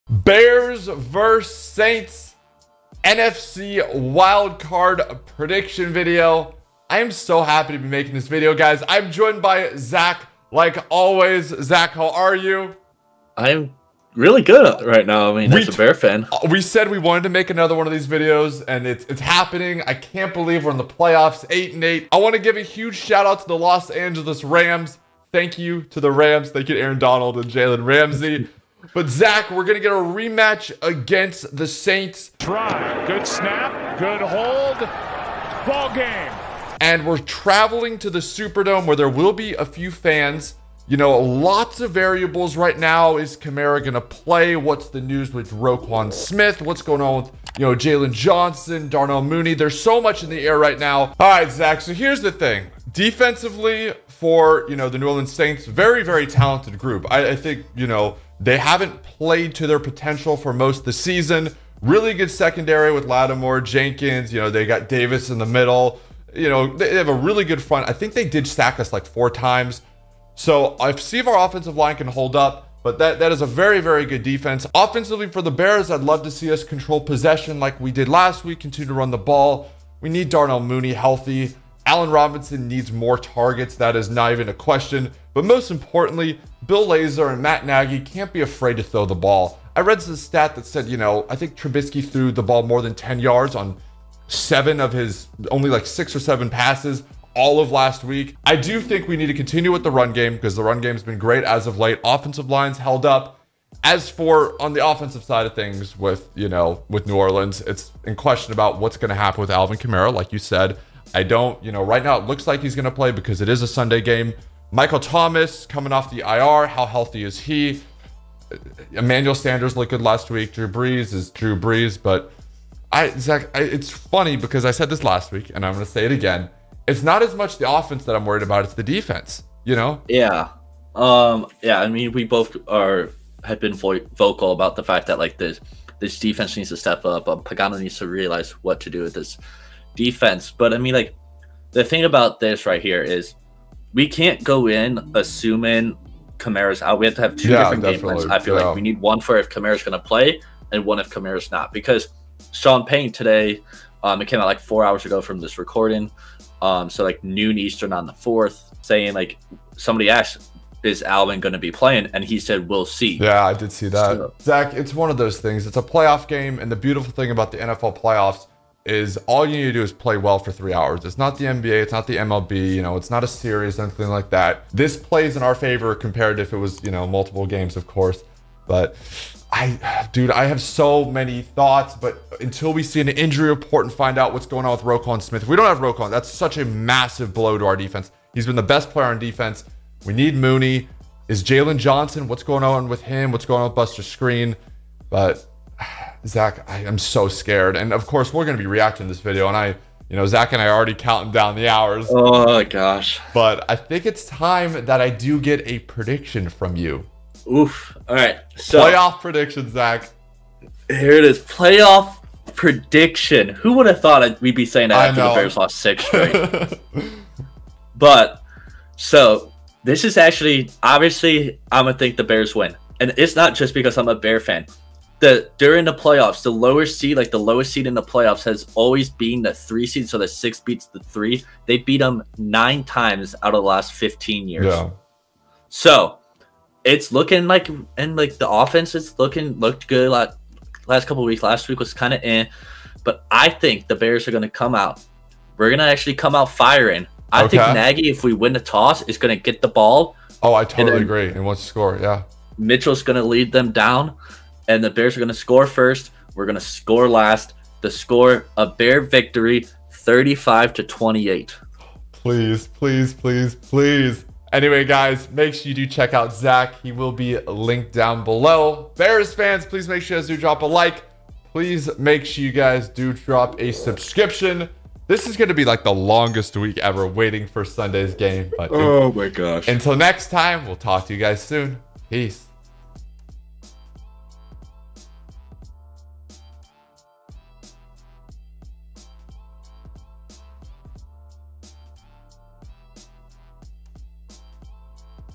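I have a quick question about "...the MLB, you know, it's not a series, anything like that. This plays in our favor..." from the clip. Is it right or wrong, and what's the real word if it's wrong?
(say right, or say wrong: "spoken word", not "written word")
right.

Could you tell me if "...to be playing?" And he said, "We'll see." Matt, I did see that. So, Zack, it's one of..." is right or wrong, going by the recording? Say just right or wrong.
wrong.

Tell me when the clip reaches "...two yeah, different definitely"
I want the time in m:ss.
2:27.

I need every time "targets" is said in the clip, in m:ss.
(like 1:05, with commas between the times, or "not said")
1:23.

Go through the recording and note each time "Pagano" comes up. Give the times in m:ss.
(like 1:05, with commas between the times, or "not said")
2:17.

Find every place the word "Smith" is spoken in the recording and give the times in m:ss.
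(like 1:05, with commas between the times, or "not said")
0:46, 3:05.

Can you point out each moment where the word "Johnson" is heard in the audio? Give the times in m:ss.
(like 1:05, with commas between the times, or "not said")
0:48, 3:11.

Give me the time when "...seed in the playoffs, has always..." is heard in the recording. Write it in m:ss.
3:47.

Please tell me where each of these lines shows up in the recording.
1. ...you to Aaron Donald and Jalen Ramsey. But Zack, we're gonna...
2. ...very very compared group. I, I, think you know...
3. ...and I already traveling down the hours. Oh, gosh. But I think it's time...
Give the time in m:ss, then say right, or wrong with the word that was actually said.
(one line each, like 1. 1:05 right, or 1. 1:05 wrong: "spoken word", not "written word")
1. 0:26 right
2. 0:55 wrong: "talented", not "compared"
3. 3:20 wrong: "counting", not "traveling".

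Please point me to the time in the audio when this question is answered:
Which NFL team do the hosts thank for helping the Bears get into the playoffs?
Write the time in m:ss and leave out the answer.
0:23.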